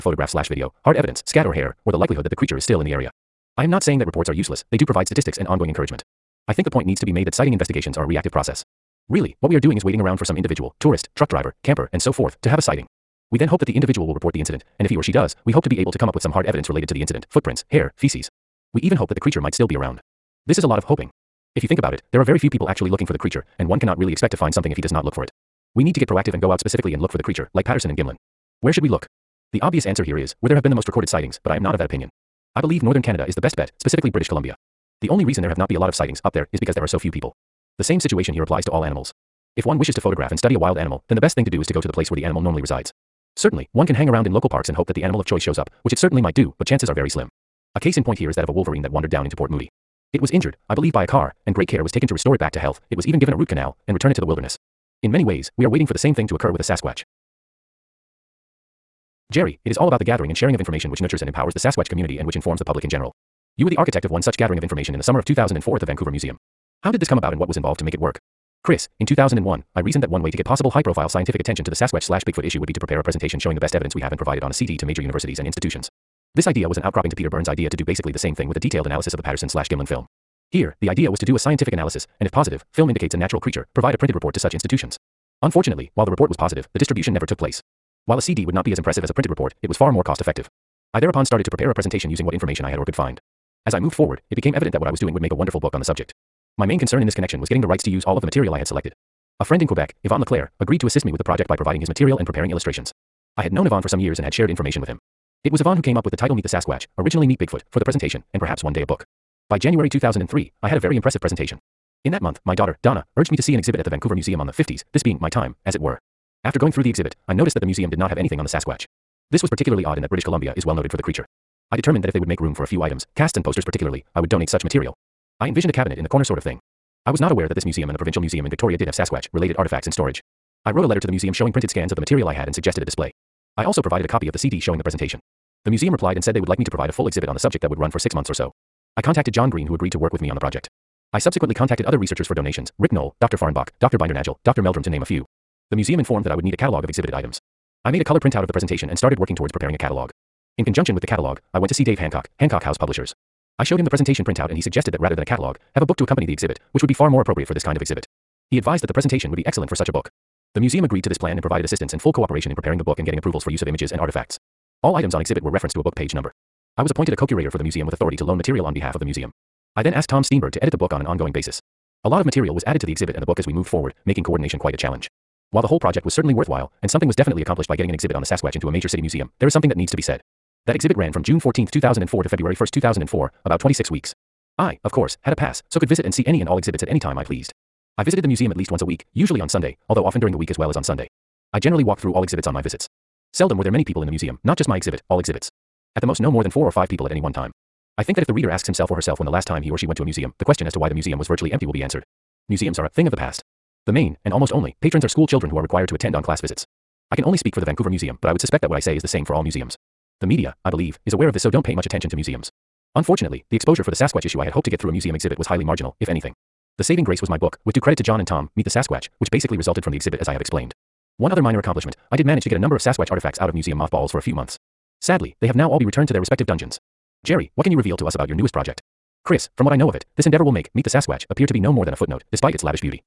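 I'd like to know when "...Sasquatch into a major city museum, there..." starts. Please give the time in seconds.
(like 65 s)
178 s.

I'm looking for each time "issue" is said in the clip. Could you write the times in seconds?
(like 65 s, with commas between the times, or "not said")
72 s, 214 s.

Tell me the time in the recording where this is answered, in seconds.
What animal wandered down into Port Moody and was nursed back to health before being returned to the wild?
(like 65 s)
48 s.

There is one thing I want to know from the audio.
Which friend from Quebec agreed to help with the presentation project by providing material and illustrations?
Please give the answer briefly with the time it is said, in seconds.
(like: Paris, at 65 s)
Yvon Leclerc, at 100 s.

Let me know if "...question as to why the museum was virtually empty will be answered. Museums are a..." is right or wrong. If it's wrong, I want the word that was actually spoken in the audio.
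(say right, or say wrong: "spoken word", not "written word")
right.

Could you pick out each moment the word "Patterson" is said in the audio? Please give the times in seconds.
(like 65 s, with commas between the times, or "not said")
27 s, 79 s.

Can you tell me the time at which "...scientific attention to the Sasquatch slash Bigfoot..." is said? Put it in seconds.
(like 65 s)
71 s.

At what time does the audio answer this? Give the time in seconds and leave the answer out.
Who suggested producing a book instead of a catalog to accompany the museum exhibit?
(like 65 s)
151 s.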